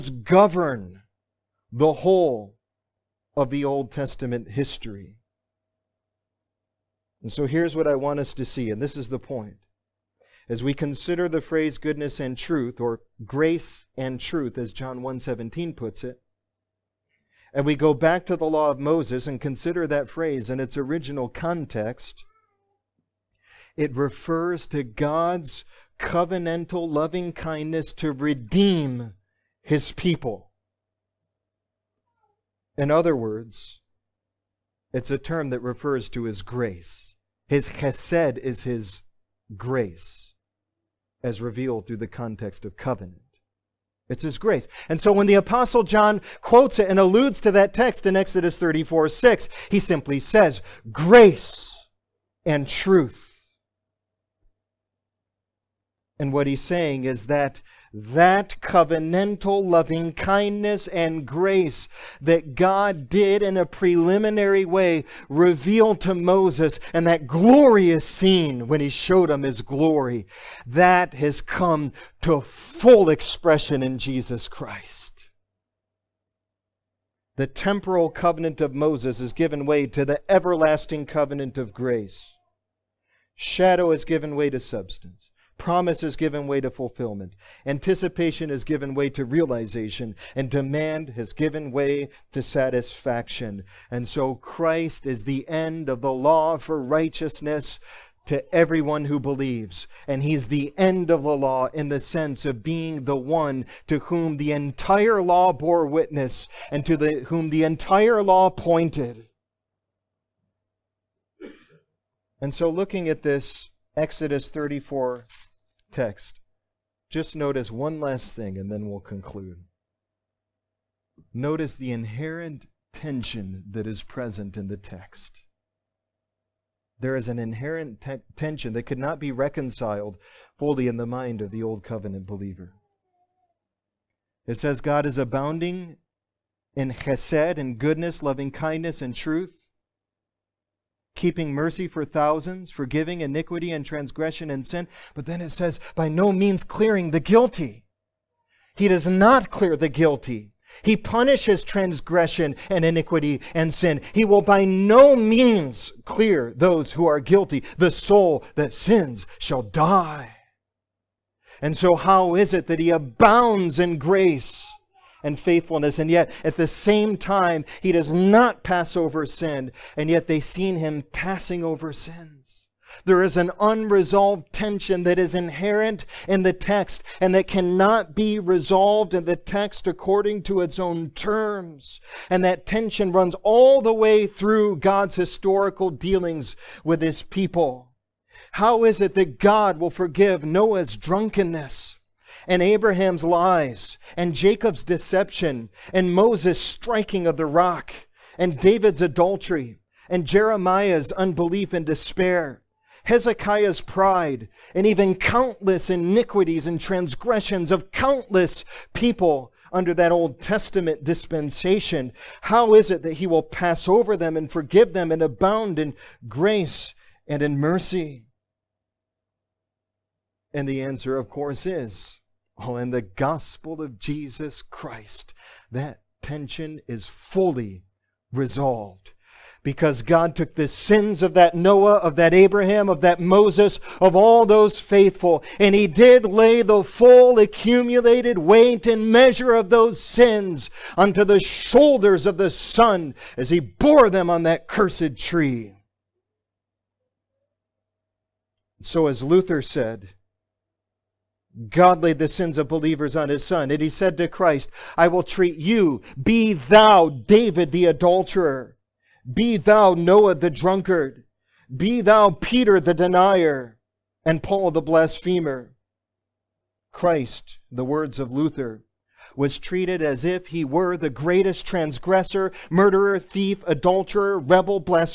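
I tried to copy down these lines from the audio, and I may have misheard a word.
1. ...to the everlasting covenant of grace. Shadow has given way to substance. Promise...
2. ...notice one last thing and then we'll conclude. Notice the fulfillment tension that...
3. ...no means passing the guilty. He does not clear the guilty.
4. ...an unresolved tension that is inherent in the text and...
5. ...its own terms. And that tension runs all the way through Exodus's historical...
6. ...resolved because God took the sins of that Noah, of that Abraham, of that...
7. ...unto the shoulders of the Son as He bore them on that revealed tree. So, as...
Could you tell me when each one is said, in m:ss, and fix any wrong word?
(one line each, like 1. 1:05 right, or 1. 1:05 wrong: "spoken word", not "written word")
1. 1:19 right
2. 1:57 wrong: "inherent", not "fulfillment"
3. 2:26 wrong: "clearing", not "passing"
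4. 2:53 right
5. 3:00 wrong: "God", not "Exodus"
6. 3:48 right
7. 4:00 wrong: "cursed", not "revealed".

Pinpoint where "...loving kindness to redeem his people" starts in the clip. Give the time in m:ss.
0:26.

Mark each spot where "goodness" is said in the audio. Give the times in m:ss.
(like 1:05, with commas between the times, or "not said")
0:11, 2:17.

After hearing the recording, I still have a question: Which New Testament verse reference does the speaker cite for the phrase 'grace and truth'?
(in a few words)
John 1:17.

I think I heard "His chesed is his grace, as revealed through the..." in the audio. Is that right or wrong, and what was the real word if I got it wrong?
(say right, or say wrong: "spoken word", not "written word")
right.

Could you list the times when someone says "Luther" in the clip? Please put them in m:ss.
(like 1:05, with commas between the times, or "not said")
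4:09, 4:28.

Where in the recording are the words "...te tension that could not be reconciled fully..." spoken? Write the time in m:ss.
2:08.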